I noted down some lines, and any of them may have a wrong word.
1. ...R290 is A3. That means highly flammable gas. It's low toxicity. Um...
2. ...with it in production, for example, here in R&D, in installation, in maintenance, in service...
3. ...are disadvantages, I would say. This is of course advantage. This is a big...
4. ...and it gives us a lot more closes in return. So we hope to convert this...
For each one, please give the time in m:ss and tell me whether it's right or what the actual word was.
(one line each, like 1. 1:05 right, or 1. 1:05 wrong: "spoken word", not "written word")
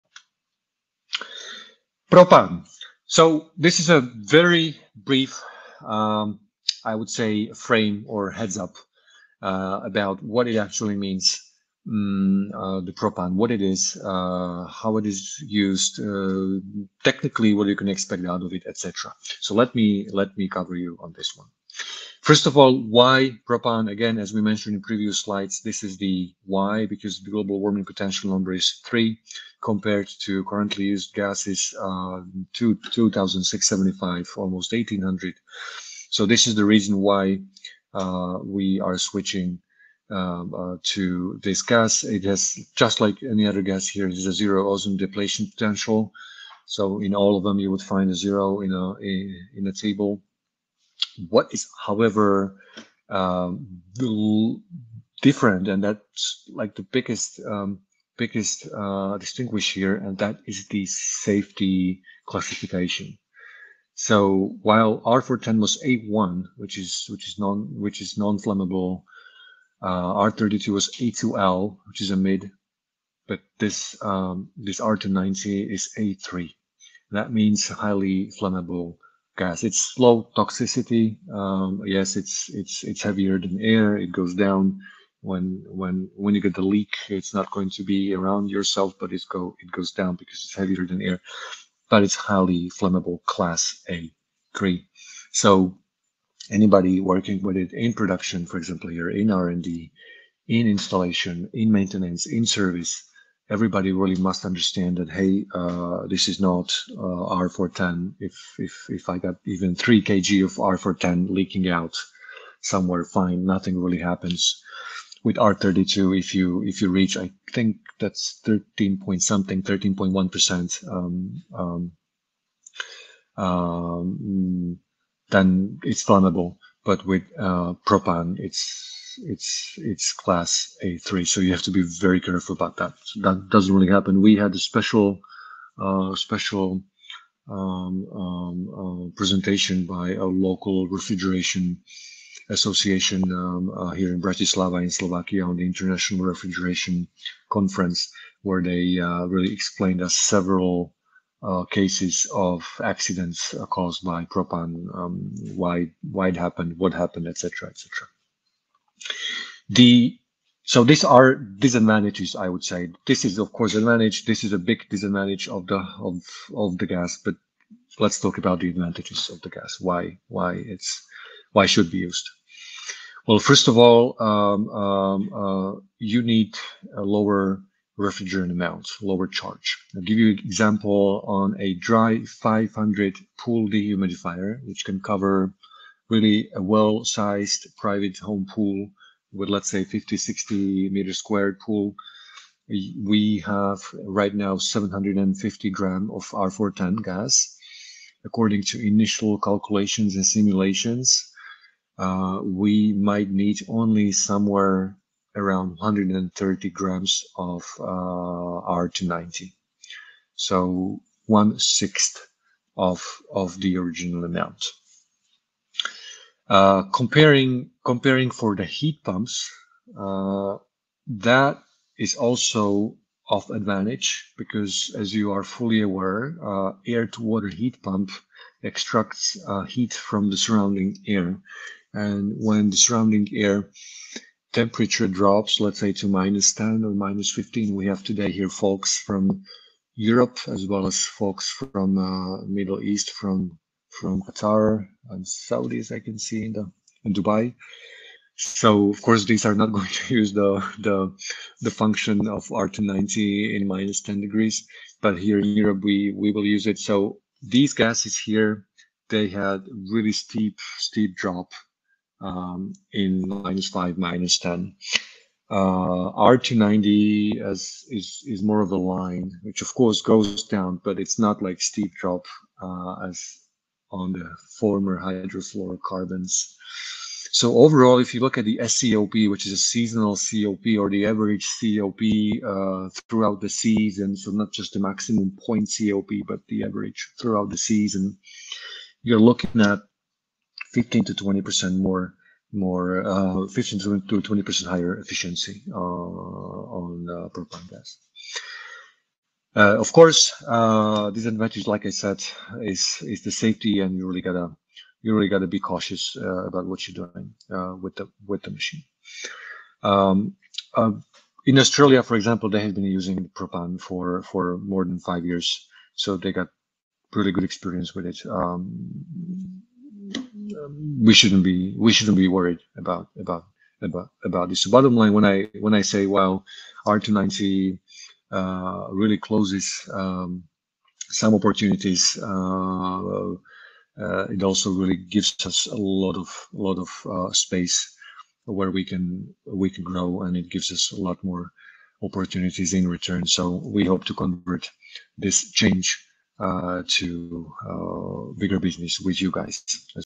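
1. 1:14 right
2. 1:37 right
3. 2:41 right
4. 5:40 wrong: "opportunities", not "closes".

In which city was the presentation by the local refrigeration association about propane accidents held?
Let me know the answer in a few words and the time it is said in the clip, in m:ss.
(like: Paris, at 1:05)
Bratislava, at 2:24.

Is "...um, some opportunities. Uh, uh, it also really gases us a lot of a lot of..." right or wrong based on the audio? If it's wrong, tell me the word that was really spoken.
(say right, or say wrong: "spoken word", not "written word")
wrong: "gives", not "gases".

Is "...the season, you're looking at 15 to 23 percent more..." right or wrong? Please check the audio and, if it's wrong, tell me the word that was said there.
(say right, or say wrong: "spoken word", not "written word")
wrong: "20", not "23".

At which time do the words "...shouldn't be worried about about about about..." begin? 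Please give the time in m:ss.
5:21.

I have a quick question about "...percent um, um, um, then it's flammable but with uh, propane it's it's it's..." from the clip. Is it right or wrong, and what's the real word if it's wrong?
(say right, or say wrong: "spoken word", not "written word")
right.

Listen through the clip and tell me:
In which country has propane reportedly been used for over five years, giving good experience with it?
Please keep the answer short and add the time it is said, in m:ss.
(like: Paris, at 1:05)
Australia, at 5:11.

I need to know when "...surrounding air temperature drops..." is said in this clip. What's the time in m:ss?
3:52.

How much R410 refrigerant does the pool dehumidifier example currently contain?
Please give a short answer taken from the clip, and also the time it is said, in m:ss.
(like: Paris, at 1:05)
750 grams, at 3:14.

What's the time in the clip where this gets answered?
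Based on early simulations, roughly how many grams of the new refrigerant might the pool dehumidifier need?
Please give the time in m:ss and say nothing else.
3:25.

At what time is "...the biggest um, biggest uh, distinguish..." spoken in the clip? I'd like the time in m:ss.
0:56.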